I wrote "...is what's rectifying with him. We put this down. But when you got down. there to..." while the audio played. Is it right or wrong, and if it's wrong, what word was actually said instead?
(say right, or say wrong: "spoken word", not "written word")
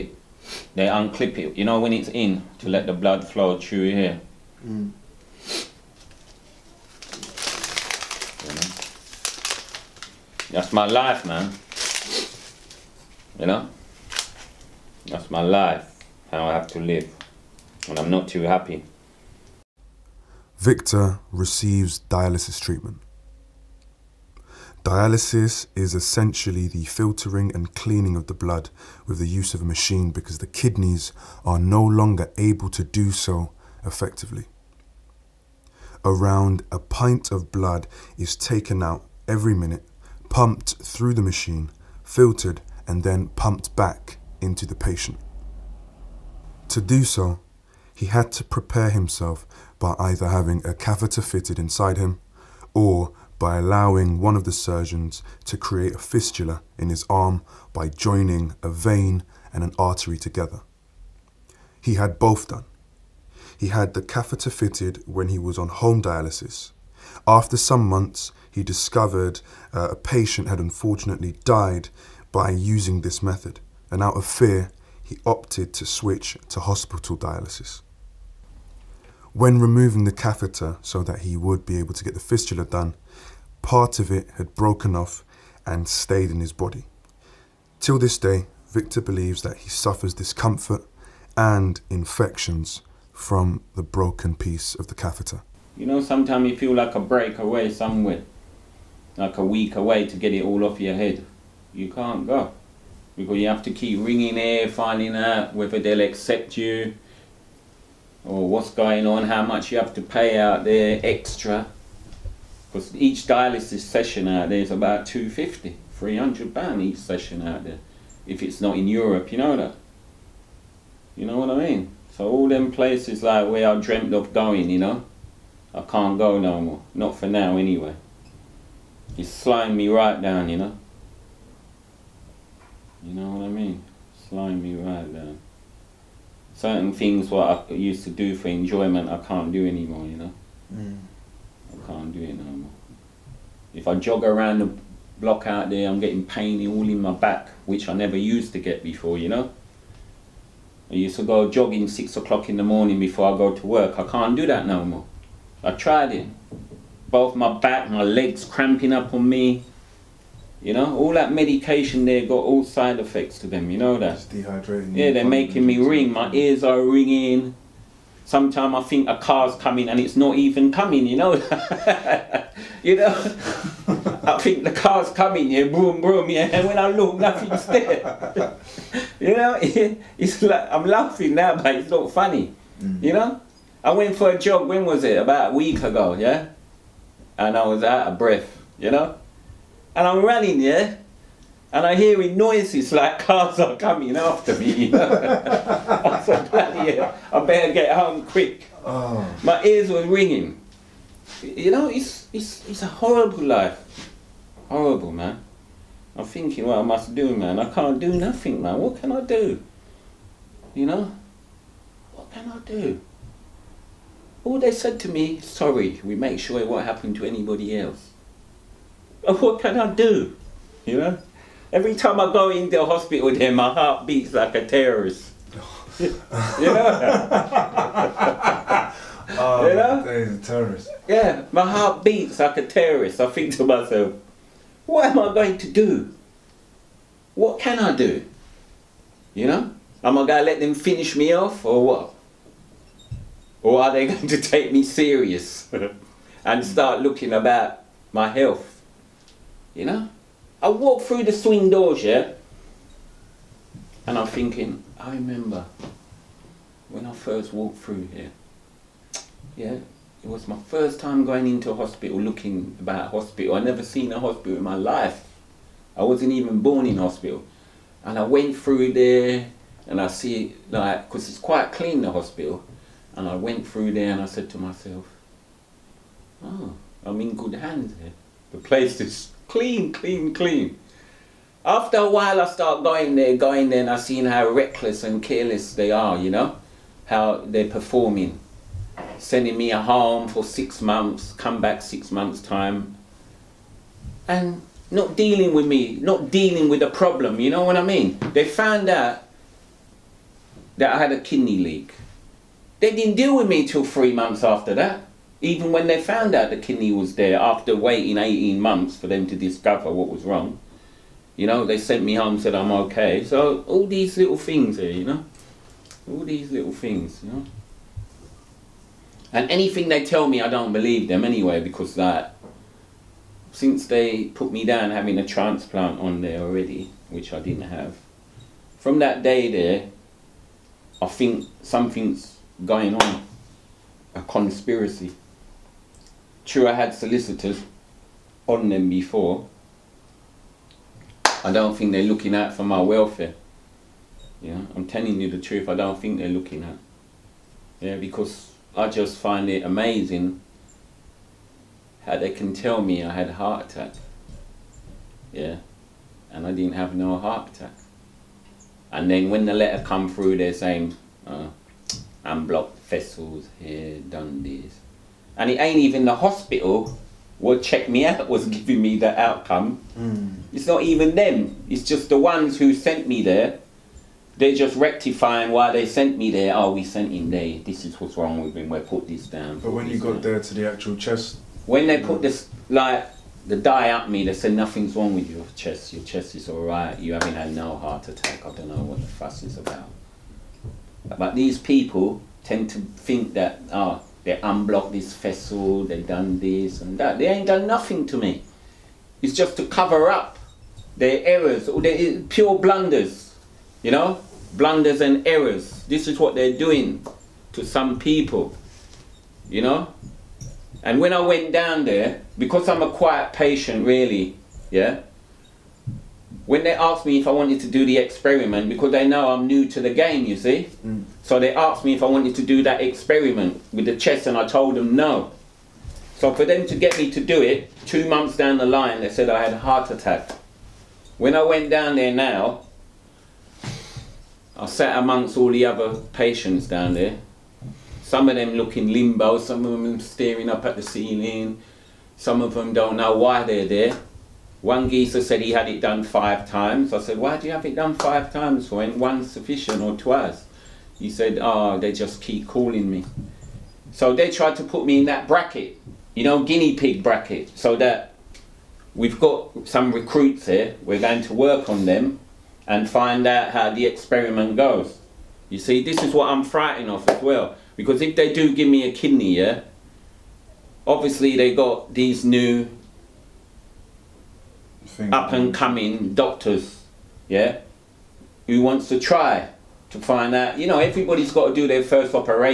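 wrong: "wrong", not "rectifying".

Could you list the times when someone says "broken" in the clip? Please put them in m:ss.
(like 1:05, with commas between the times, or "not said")
1:24, 1:33.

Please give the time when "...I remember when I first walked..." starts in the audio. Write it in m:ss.
4:14.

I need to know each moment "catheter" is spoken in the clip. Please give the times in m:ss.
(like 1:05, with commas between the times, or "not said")
0:50, 1:04, 1:20, 1:34.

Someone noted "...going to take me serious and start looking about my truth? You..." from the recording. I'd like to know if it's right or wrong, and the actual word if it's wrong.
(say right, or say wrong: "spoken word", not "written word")
wrong: "health", not "truth".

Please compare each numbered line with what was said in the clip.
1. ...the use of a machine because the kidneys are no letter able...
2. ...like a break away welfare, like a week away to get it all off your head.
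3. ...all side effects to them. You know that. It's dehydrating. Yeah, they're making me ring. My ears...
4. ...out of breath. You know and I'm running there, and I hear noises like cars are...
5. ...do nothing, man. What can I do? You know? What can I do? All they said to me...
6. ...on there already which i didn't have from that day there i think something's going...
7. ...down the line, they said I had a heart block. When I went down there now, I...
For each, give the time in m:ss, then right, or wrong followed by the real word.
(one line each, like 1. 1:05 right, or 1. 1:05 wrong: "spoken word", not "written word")
1. 0:29 wrong: "longer", not "letter"
2. 1:36 wrong: "somewhere", not "welfare"
3. 2:42 right
4. 3:07 right
5. 3:27 right
6. 5:25 right
7. 7:08 wrong: "attack", not "block".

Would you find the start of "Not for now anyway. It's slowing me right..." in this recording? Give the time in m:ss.
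2:06.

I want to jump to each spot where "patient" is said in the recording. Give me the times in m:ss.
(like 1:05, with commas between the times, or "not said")
0:44, 1:09, 6:53, 7:16.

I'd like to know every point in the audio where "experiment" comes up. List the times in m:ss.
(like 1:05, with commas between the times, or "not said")
6:57, 7:02, 7:43.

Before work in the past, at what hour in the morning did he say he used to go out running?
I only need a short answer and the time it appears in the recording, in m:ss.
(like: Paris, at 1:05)
6 o'clock, at 2:31.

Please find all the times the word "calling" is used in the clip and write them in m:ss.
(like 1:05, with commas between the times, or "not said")
7:32.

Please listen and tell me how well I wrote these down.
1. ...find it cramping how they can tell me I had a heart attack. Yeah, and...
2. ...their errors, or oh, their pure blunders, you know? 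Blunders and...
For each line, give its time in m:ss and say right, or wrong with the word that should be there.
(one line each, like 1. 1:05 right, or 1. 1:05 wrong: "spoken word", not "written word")
1. 5:49 wrong: "amazing", not "cramping"
2. 6:40 right.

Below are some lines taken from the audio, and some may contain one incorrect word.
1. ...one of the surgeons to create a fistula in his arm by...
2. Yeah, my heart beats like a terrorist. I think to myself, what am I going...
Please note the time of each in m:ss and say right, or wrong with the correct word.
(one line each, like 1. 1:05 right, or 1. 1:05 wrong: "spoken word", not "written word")
1. 0:54 right
2. 3:51 right.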